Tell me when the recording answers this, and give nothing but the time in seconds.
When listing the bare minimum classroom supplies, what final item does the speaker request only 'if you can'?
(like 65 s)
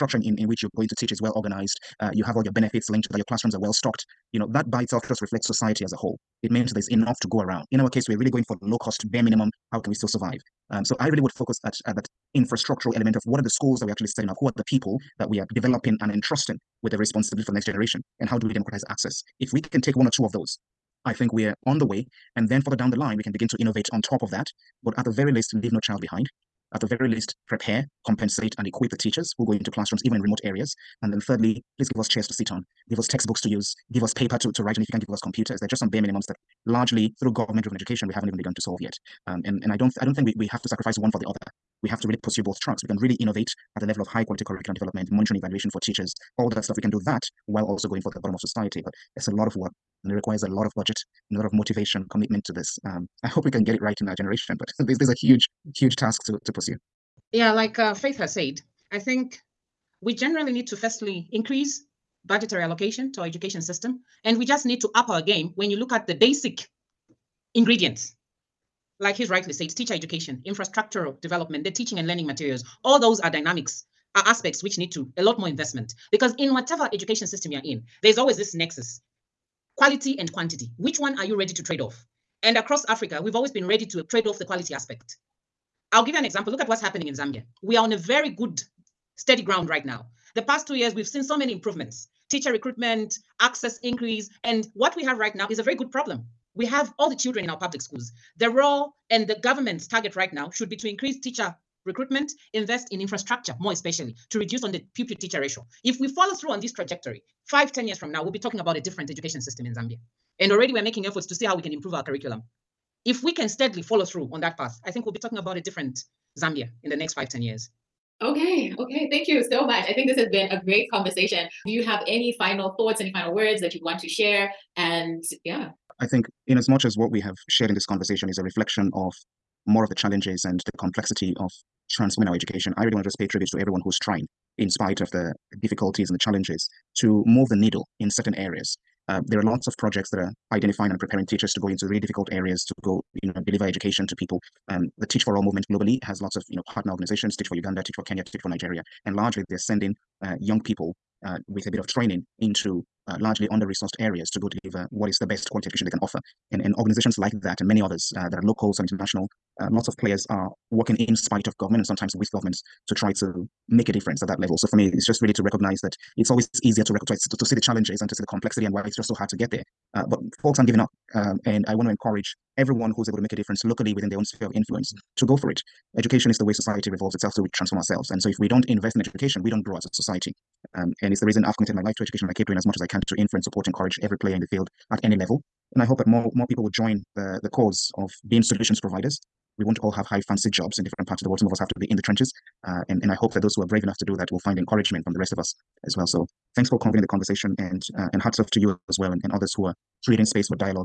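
35 s.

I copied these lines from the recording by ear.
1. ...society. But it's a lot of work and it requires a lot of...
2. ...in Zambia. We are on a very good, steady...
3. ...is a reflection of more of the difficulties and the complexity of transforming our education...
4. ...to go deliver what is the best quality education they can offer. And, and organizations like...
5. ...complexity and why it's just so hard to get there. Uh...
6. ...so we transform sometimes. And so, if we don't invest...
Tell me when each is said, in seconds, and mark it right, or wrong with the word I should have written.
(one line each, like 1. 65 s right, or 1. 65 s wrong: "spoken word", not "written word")
1. 48 s right
2. 87 s right
3. 128 s wrong: "challenges", not "difficulties"
4. 154 s right
5. 168 s right
6. 177 s wrong: "ourselves", not "sometimes".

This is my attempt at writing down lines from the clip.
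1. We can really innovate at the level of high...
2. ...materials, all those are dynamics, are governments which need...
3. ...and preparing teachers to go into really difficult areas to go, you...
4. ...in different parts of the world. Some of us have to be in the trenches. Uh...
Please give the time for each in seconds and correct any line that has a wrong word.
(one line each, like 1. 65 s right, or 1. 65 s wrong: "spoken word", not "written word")
1. 42 s right
2. 72 s wrong: "aspects", not "governments"
3. 140 s right
4. 190 s right.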